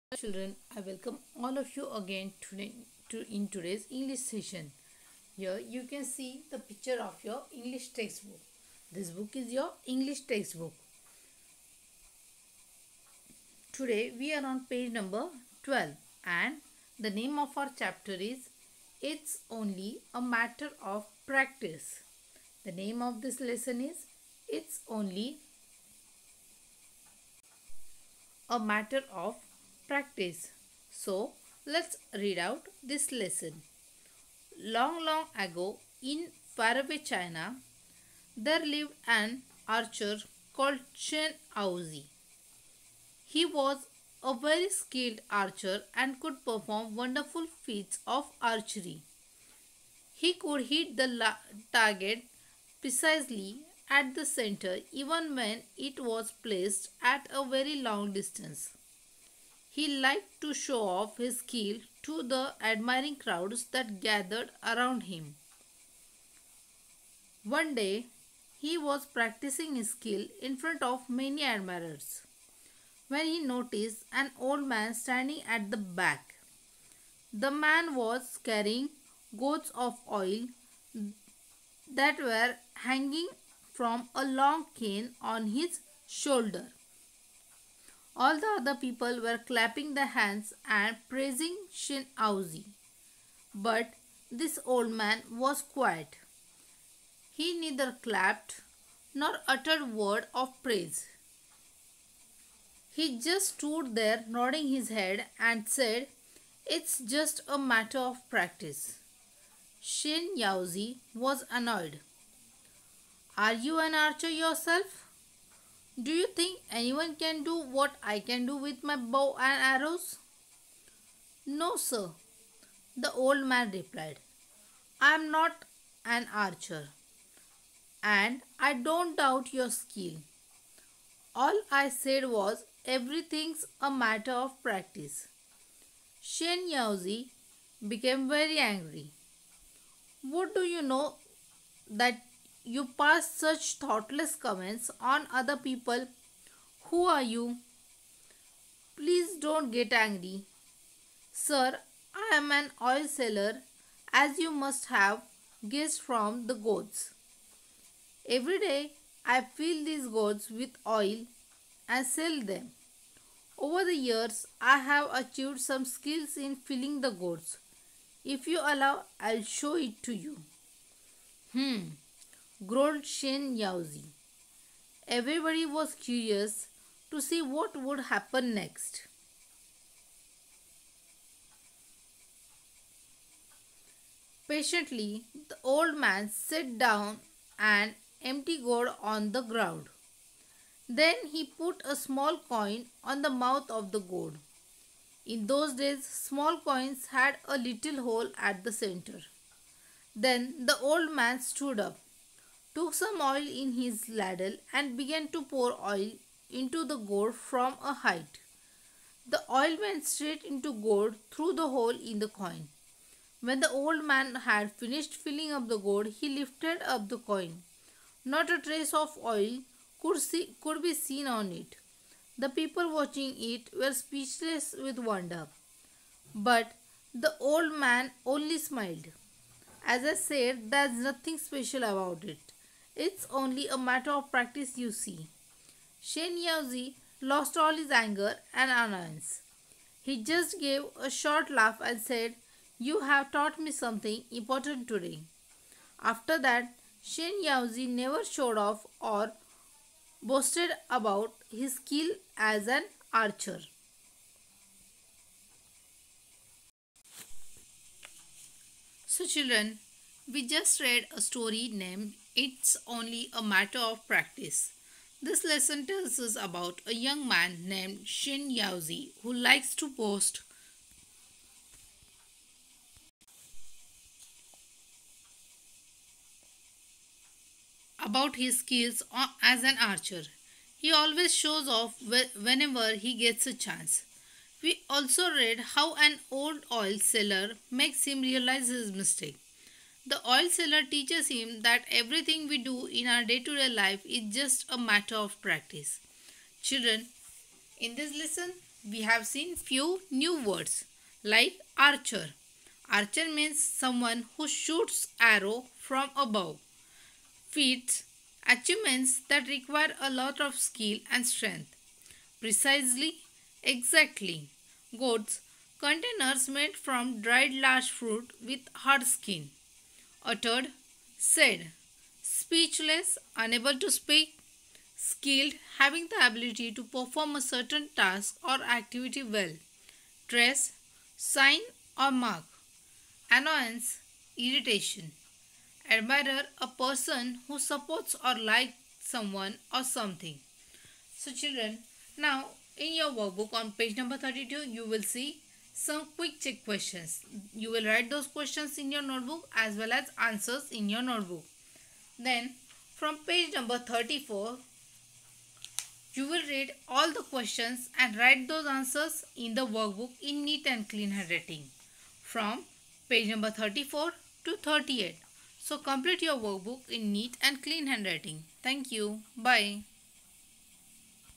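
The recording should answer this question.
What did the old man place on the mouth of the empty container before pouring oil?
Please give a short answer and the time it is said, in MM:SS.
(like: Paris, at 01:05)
A small coin, at 03:11.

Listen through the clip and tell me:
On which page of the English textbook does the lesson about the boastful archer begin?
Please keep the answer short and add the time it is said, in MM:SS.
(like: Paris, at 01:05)
12, at 00:14.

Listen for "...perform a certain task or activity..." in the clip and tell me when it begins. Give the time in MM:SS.
05:26.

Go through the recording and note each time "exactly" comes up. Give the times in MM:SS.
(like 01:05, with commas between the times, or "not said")
05:13.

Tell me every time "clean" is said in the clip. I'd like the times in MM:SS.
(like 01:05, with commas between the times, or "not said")
06:00, 06:07.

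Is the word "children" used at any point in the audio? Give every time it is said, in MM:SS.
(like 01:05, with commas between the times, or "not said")
00:00, 04:19, 04:56, 05:41.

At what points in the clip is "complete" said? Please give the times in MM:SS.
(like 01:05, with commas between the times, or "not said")
06:05.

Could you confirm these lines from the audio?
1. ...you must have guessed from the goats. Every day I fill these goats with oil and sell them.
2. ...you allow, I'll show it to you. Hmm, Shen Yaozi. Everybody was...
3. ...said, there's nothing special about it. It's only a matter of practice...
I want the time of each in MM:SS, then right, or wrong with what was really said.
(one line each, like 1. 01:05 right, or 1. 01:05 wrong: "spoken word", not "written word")
1. 02:34 right
2. 02:48 wrong: "Grolchen", not "Shen"
3. 03:50 right.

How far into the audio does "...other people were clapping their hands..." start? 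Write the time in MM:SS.
01:28.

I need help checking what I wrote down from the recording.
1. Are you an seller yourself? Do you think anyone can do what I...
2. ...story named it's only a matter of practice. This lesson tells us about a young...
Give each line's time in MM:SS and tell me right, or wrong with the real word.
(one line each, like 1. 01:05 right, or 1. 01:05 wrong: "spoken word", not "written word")
1. 01:53 wrong: "archer", not "seller"
2. 04:21 right.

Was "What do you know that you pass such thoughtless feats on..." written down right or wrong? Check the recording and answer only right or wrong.
wrong.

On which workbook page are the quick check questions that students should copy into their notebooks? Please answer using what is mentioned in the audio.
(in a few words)
32.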